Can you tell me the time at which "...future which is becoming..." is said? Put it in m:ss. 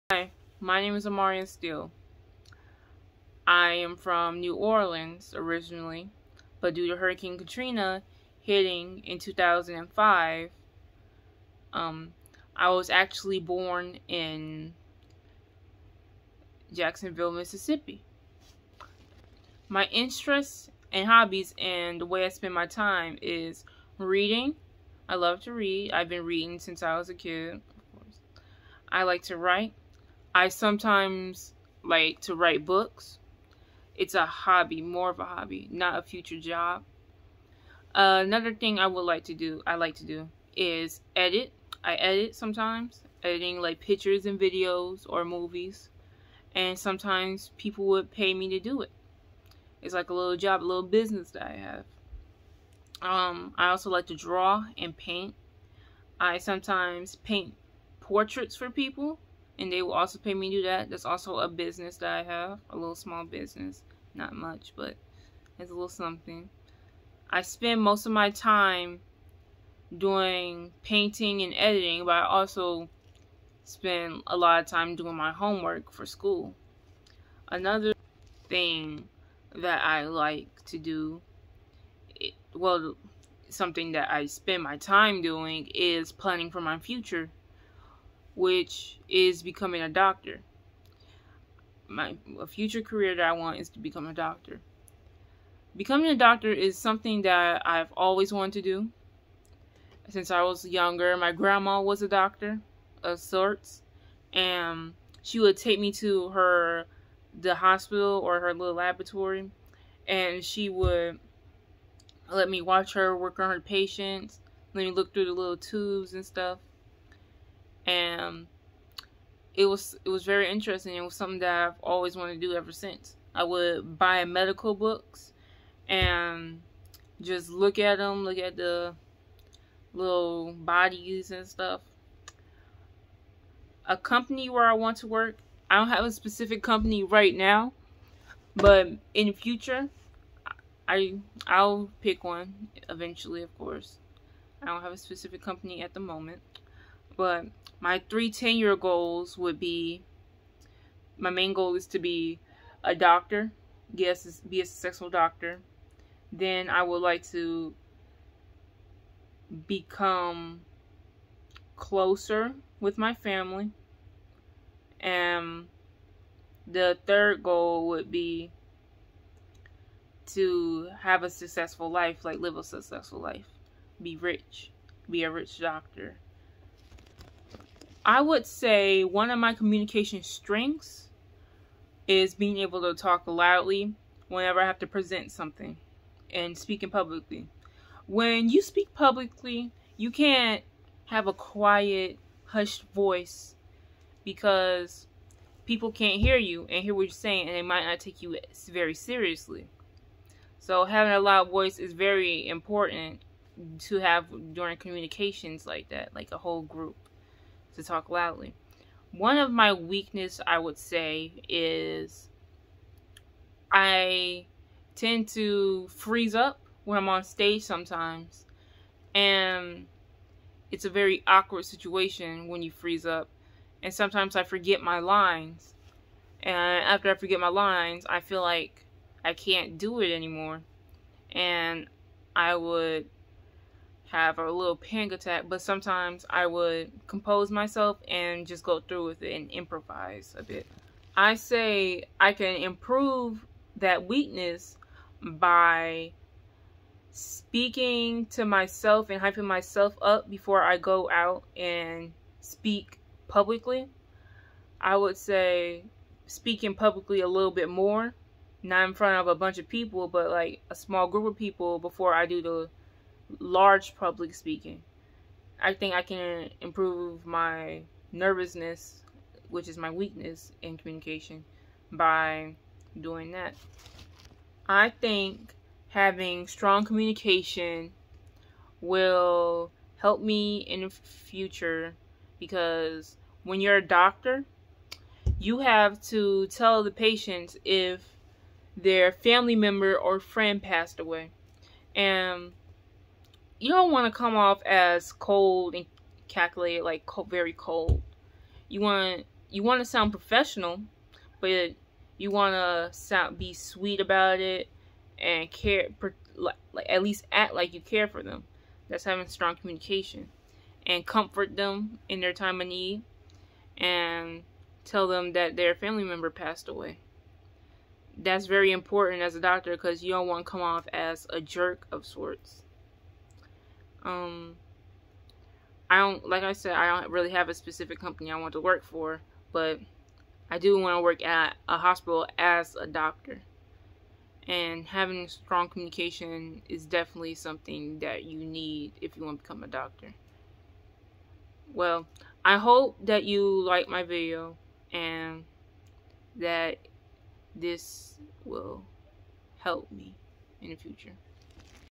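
1:26.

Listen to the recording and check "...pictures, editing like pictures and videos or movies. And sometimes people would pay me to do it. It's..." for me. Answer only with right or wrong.
wrong.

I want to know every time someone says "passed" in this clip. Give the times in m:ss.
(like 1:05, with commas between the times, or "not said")
4:50, 5:16.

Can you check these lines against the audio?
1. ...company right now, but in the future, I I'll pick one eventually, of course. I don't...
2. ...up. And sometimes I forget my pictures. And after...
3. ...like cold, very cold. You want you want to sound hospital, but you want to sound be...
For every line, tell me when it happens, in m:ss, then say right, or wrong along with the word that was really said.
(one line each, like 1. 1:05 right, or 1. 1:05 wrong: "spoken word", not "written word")
1. 2:16 right
2. 3:43 wrong: "lines", not "pictures"
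3. 4:56 wrong: "professional", not "hospital".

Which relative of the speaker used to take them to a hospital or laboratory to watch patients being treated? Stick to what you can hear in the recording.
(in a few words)
Grandma.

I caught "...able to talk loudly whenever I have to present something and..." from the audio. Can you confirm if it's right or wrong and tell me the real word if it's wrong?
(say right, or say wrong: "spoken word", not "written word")
right.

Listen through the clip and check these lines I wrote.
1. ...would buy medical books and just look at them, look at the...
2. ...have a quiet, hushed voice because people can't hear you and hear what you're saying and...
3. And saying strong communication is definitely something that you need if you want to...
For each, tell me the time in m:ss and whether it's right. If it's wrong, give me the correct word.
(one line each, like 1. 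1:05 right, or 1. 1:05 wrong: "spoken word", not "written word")
1. 2:03 right
2. 3:11 right
3. 5:34 wrong: "having", not "saying".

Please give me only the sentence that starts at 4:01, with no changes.
I say I can improve that weakness by speaking to myself and hyping myself up before I go out and speak publicly.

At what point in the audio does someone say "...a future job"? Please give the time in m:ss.
0:35.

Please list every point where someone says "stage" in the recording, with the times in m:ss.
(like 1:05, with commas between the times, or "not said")
3:37.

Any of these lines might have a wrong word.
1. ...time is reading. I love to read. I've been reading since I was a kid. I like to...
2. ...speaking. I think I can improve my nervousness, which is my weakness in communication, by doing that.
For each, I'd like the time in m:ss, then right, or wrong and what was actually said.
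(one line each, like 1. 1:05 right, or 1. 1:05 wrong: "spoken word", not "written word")
1. 0:22 right
2. 4:24 right.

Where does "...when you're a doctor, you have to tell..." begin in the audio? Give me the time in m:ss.
4:43.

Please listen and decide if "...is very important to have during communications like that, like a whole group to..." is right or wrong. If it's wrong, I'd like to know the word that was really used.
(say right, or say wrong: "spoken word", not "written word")
right.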